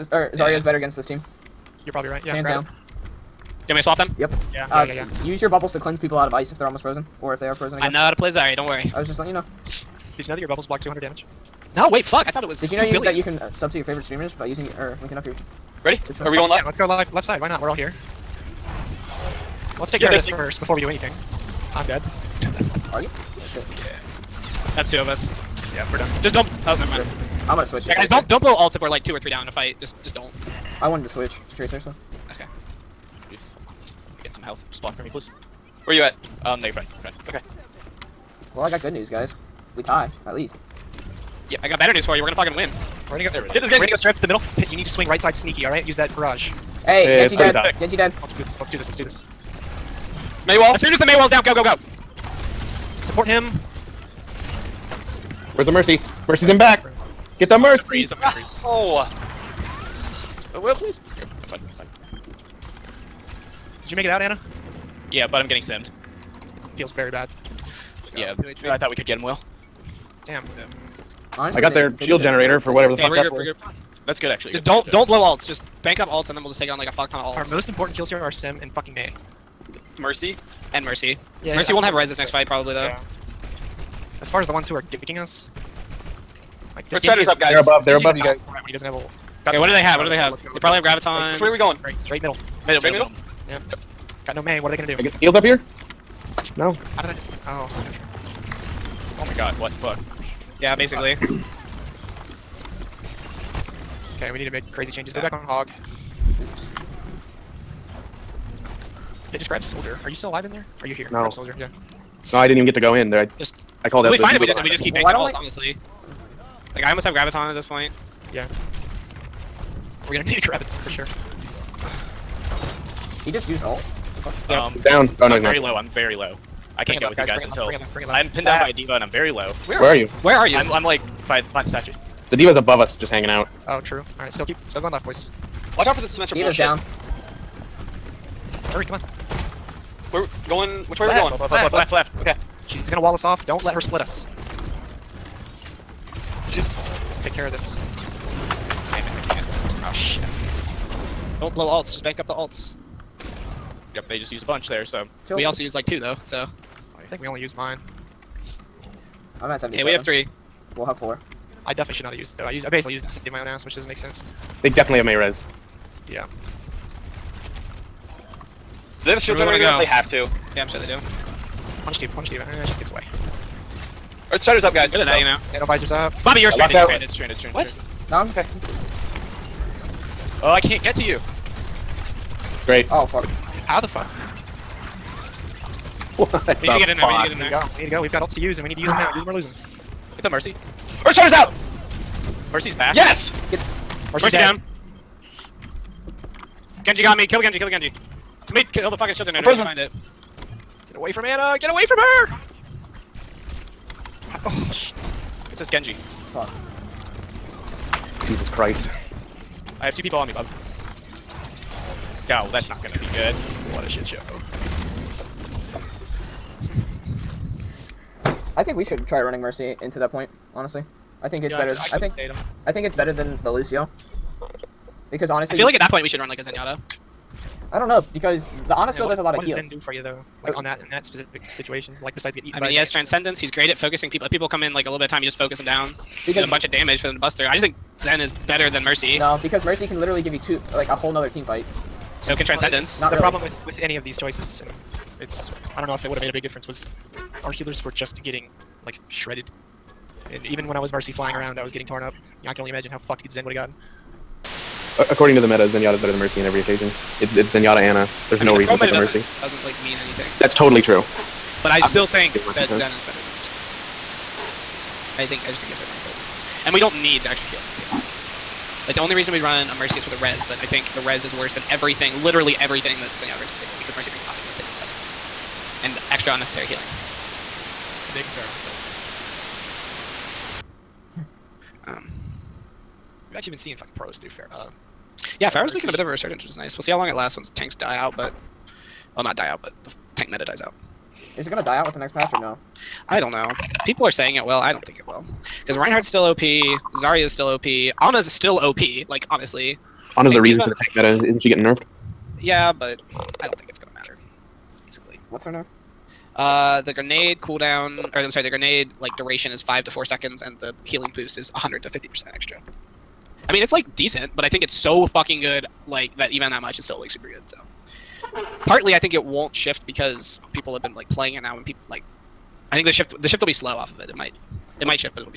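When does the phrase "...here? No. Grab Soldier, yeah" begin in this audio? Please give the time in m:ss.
1:50.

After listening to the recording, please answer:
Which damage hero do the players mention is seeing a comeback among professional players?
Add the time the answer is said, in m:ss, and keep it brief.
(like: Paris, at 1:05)
Pharah, at 4:45.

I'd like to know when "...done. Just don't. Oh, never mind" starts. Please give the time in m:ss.
0:25.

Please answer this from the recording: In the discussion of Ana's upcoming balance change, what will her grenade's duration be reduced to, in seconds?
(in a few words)
4.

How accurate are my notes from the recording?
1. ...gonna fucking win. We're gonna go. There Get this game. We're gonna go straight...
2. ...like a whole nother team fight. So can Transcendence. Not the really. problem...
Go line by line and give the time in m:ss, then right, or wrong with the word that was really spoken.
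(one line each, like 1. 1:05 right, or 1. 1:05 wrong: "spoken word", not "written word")
1. 0:42 right
2. 4:00 right.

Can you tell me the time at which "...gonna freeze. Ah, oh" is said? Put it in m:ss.
0:58.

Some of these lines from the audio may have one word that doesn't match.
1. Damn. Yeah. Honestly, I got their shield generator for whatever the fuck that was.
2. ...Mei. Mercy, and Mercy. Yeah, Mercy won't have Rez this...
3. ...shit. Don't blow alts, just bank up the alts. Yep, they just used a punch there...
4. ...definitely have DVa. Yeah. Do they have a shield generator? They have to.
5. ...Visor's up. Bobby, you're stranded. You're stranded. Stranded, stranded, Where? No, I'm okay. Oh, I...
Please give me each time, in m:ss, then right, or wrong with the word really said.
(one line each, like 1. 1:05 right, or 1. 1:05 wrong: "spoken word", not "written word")
1. 1:10 right
2. 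1:18 right
3. 2:29 wrong: "bunch", not "punch"
4. 2:44 wrong: "Mayrez", not "DVa"
5. 2:55 wrong: "What", not "Where".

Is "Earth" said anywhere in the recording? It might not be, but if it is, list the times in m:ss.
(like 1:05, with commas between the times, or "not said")
2:54, 3:11.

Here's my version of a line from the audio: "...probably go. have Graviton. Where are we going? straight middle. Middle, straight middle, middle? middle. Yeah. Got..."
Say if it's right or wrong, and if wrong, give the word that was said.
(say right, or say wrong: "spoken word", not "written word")
right.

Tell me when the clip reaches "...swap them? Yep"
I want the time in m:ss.
0:03.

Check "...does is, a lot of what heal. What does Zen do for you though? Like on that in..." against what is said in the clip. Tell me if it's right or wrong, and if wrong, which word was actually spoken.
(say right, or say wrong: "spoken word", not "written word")
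right.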